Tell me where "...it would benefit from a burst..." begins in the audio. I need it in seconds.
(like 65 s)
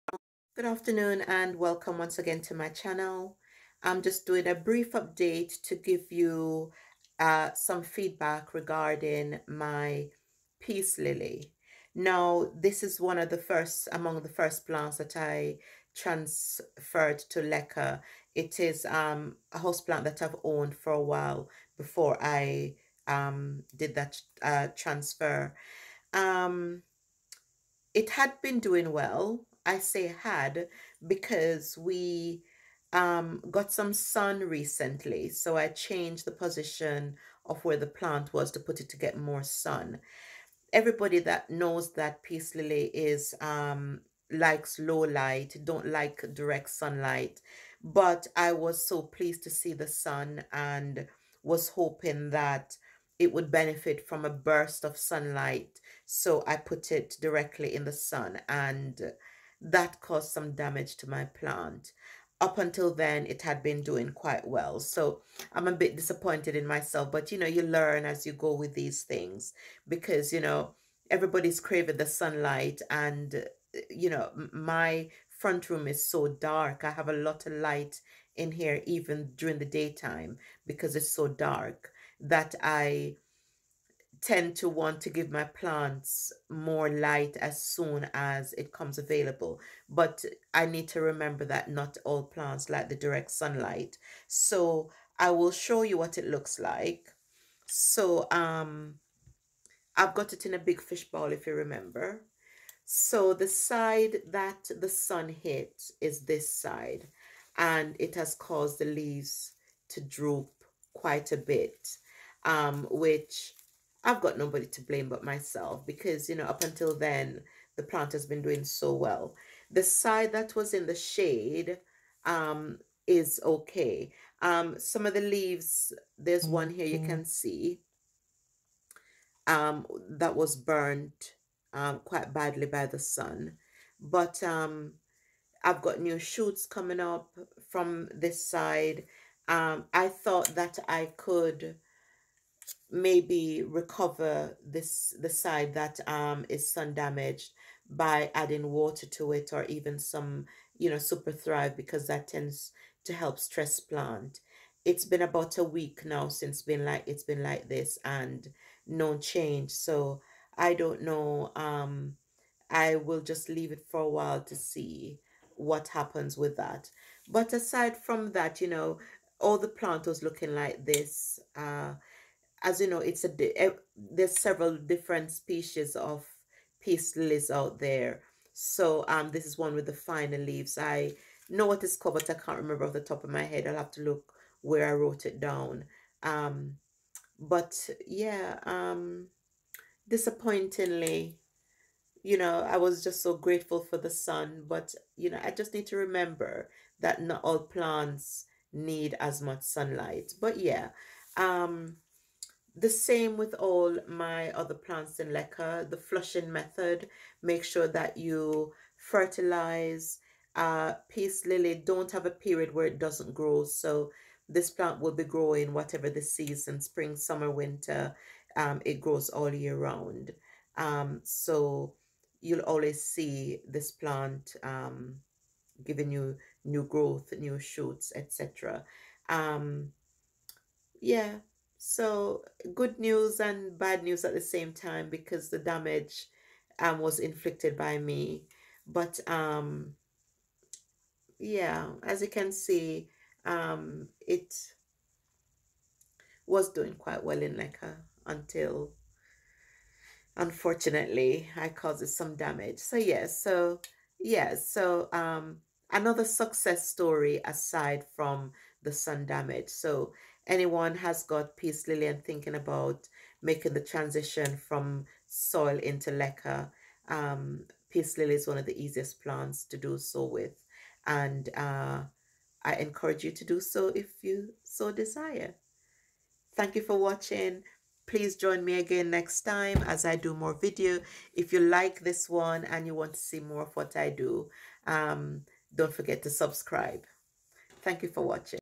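53 s.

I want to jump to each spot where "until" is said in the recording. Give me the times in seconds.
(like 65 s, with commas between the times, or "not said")
62 s, 116 s, 248 s.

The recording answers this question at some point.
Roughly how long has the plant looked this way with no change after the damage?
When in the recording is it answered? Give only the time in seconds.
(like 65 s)
155 s.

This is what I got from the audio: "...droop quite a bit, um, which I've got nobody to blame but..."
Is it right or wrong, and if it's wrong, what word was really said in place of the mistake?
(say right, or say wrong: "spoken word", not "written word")
right.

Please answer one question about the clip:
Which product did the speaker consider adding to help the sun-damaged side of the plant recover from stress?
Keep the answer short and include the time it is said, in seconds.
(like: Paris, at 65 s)
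SUPERthrive, at 150 s.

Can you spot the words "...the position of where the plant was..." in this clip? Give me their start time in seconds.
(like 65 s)
36 s.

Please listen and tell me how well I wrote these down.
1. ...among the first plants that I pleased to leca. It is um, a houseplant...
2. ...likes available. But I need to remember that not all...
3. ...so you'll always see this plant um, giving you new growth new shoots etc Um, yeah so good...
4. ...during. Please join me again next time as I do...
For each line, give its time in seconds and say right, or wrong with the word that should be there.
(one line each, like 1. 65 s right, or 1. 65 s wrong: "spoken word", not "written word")
1. 13 s wrong: "transferred", not "pleased"
2. 88 s wrong: "comes", not "likes"
3. 221 s right
4. 276 s wrong: "watching", not "during".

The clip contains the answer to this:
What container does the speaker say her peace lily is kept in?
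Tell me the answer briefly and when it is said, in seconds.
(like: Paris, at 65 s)
A big fish bowl, at 100 s.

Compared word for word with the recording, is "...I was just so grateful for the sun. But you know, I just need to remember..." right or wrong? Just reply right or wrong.
right.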